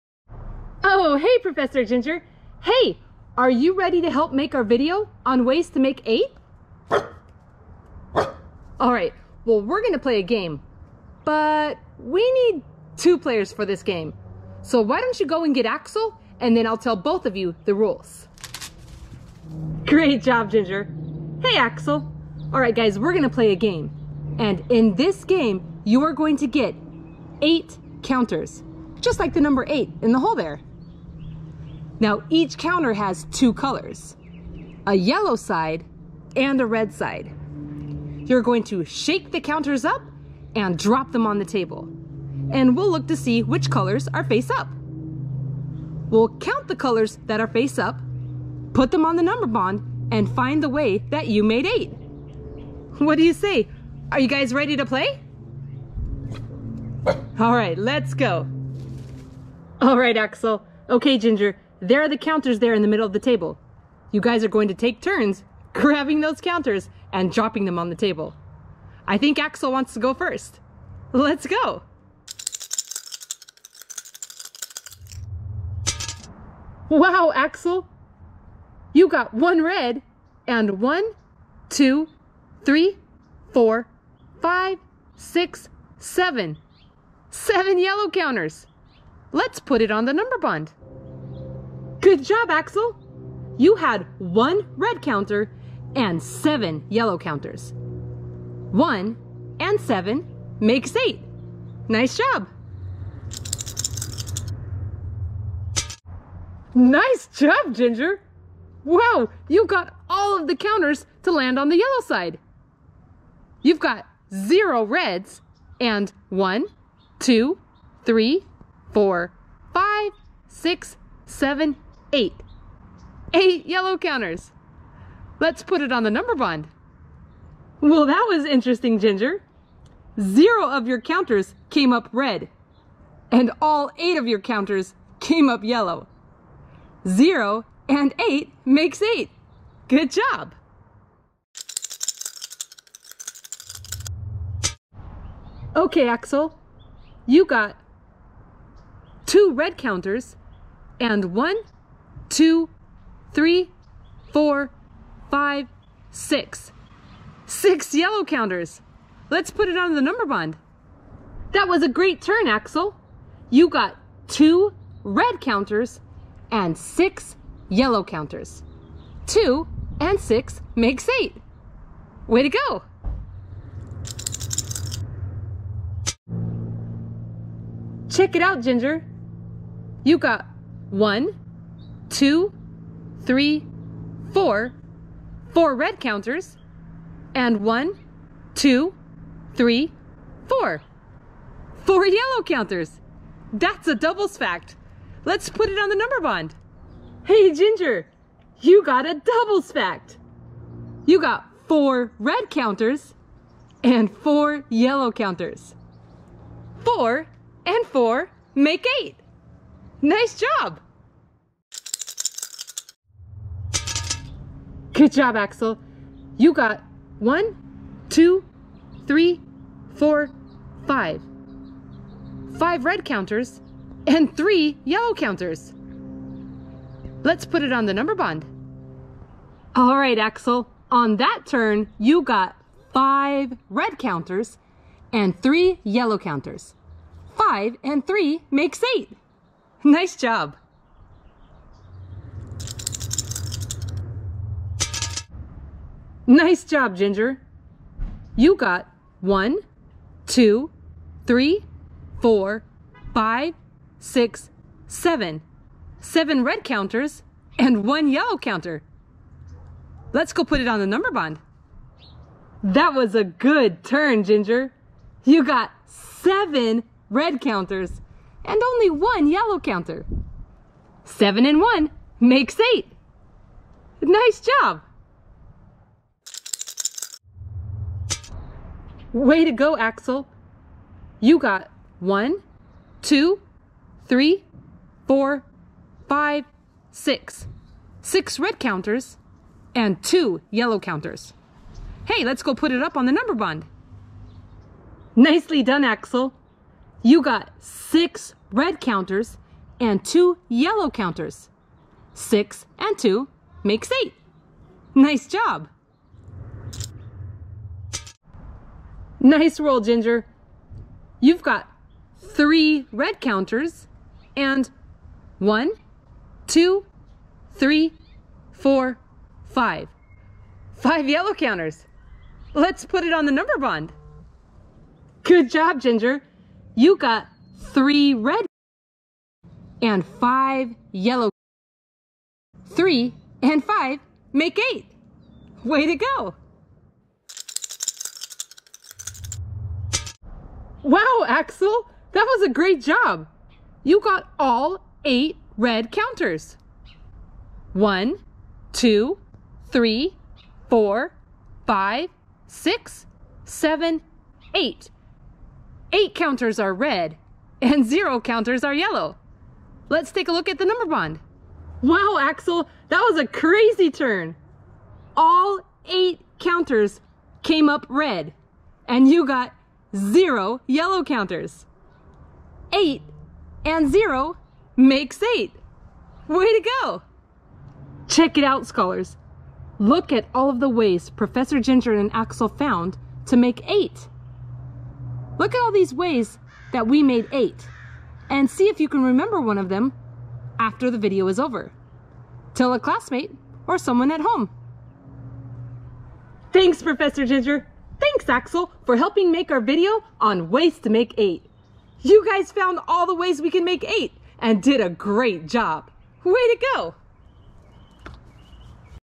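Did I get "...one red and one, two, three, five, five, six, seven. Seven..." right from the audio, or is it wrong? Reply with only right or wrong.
wrong.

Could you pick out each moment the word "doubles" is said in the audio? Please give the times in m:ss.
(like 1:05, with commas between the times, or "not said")
3:13, 3:19.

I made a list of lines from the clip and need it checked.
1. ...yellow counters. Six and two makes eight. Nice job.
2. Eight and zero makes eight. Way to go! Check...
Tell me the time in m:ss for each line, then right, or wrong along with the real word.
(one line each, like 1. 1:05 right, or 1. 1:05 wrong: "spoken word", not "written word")
1. 5:00 right
2. 6:12 right.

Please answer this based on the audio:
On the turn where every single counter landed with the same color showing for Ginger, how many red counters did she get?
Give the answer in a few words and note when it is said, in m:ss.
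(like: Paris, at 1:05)
0, at 1:54.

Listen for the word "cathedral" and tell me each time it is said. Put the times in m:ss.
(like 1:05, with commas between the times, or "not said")
not said.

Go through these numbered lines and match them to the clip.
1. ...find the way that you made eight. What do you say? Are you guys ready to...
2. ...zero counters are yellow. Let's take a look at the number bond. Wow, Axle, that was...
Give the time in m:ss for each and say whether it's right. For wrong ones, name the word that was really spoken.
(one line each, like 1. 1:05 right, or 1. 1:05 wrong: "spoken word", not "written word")
1. 0:50 right
2. 5:57 right.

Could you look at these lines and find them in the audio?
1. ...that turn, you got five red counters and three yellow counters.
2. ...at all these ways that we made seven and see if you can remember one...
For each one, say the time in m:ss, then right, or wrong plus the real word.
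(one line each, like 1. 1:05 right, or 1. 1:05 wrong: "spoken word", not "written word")
1. 3:51 right
2. 6:25 wrong: "eight", not "seven".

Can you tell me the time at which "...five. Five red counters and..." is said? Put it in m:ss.
3:40.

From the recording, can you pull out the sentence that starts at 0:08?
All right, well, we're going to play a game, but we need two players for this game.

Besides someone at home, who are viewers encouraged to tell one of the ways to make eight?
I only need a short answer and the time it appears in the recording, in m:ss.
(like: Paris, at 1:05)
A classmate, at 6:32.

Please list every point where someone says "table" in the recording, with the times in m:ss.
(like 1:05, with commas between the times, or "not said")
0:41, 1:03, 1:07.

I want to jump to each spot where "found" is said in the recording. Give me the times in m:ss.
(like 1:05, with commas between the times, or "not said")
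6:22, 6:42.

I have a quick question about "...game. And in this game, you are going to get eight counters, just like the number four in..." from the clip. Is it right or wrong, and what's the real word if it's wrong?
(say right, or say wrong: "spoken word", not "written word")
wrong: "eight", not "four".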